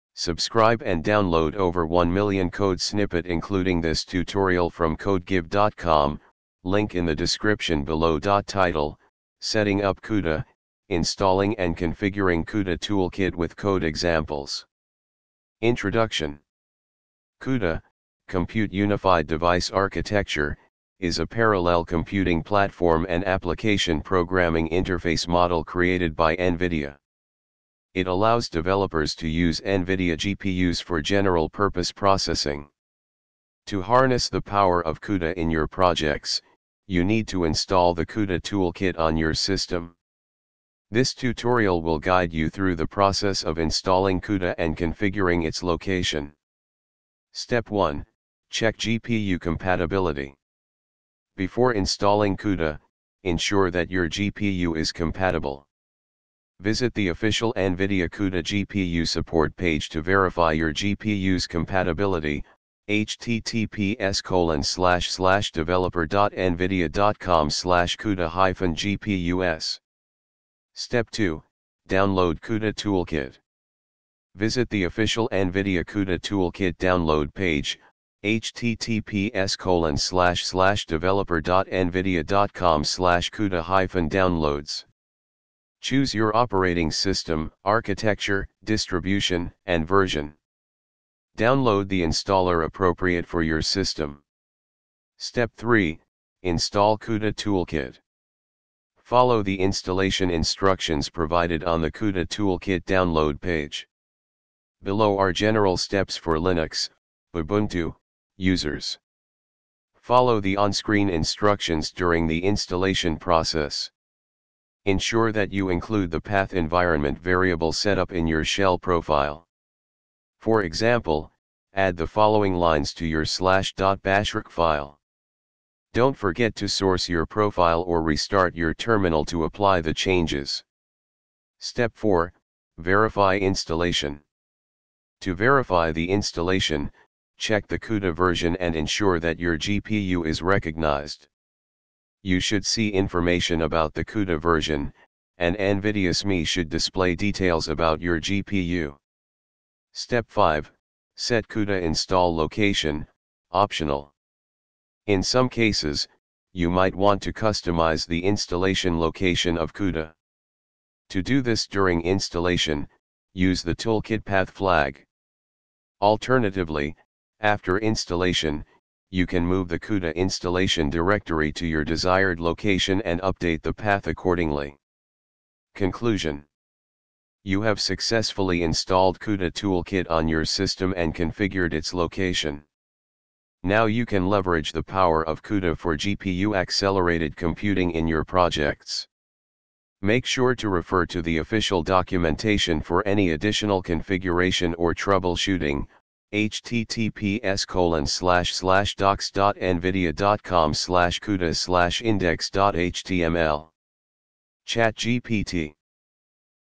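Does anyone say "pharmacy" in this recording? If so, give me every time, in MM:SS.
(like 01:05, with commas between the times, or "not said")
not said.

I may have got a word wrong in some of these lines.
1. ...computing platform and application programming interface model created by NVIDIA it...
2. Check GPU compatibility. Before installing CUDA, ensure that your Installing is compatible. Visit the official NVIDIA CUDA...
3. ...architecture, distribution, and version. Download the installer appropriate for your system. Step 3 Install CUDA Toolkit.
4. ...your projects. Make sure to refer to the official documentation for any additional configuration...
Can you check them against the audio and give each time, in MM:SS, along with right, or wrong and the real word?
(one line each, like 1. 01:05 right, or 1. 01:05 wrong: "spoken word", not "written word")
1. 00:21 right
2. 00:48 wrong: "GPU", not "Installing"
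3. 01:27 right
4. 03:08 right.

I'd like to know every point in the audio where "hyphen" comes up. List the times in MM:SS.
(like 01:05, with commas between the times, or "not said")
01:08, 01:23.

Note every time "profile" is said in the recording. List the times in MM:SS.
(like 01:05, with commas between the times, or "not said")
01:58, 02:07.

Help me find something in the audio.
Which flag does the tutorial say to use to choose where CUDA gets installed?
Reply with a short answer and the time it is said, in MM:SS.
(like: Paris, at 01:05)
toolkit path flag, at 02:43.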